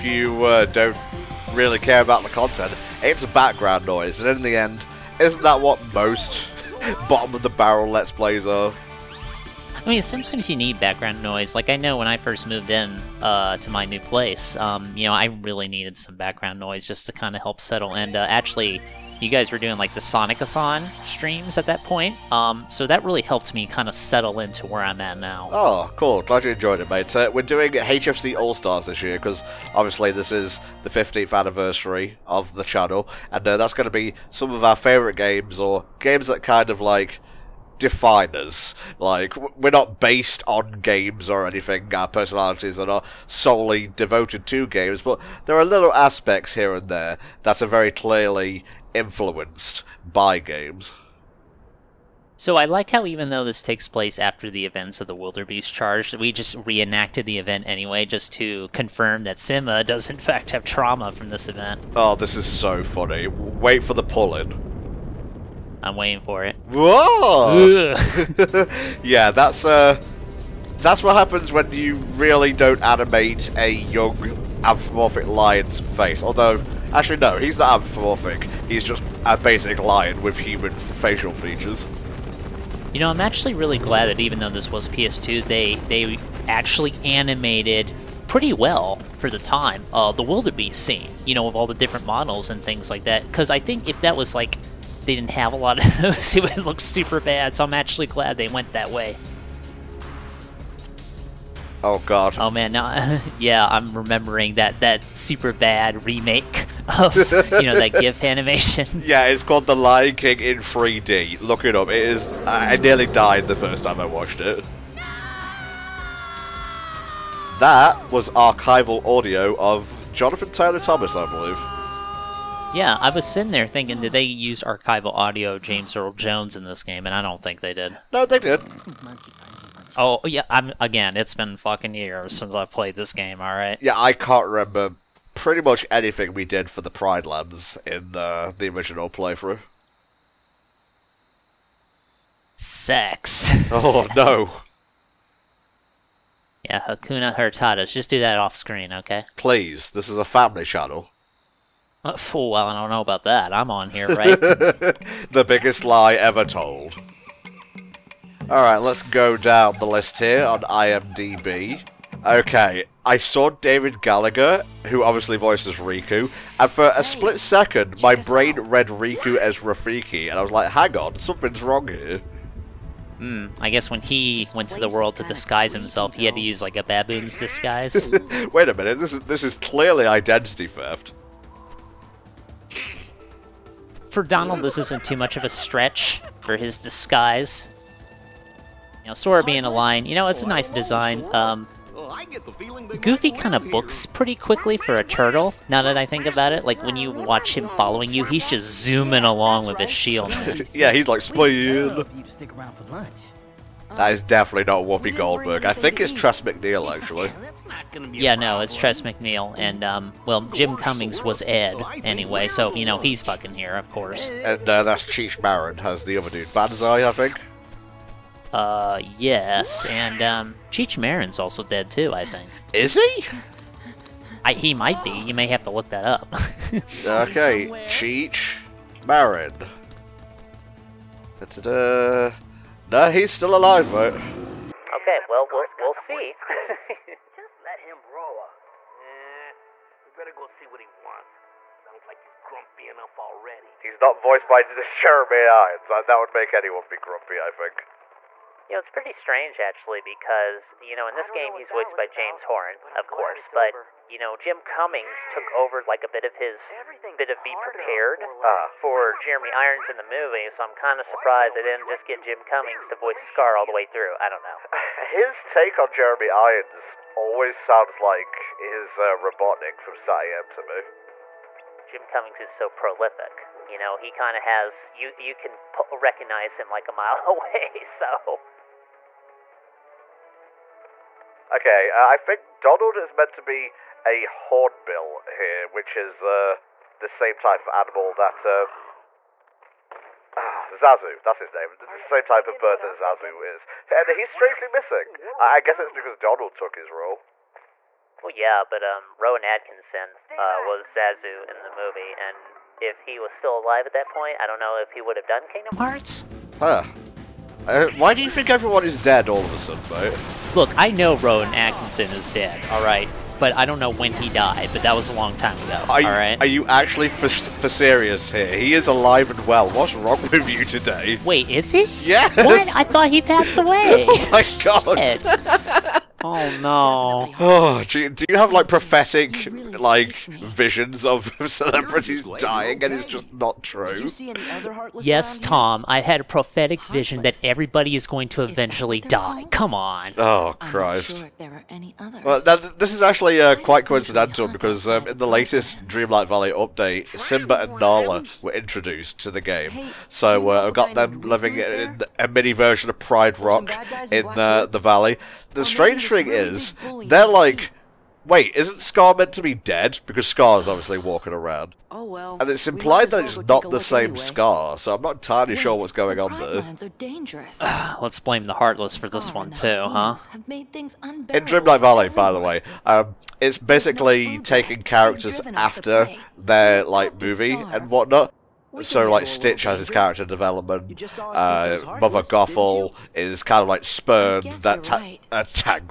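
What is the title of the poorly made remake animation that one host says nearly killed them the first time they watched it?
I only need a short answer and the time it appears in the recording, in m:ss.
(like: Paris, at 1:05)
The Lion King in 3D, at 1:49.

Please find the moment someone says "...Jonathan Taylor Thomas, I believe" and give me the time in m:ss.
2:00.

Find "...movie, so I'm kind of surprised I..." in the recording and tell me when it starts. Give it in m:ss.
4:20.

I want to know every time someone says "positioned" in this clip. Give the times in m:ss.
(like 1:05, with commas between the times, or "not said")
not said.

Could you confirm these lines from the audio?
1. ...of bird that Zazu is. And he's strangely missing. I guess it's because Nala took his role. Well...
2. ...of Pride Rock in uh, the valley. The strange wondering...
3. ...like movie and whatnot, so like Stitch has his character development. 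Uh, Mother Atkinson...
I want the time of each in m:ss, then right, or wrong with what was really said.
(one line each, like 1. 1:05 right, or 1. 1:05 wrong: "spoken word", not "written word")
1. 4:52 wrong: "Donald", not "Nala"
2. 5:52 right
3. 6:16 wrong: "Gothel", not "Atkinson".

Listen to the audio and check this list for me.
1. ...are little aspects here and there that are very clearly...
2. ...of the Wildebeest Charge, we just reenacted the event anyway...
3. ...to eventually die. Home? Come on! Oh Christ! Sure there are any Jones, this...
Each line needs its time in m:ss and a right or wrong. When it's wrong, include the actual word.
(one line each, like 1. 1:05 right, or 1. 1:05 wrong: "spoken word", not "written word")
1. 0:45 right
2. 0:54 right
3. 5:38 wrong: "Well", not "Jones".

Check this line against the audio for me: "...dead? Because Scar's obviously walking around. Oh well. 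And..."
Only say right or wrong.
right.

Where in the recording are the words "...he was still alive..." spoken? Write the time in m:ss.
5:02.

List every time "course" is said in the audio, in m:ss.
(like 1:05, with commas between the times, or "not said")
3:33, 4:13.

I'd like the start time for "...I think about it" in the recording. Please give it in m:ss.
3:15.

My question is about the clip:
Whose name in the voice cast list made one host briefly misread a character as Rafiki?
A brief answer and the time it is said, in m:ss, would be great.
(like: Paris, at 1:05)
David Gallagher, at 2:43.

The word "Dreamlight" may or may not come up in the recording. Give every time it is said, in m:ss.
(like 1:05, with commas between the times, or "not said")
5:45, 6:10.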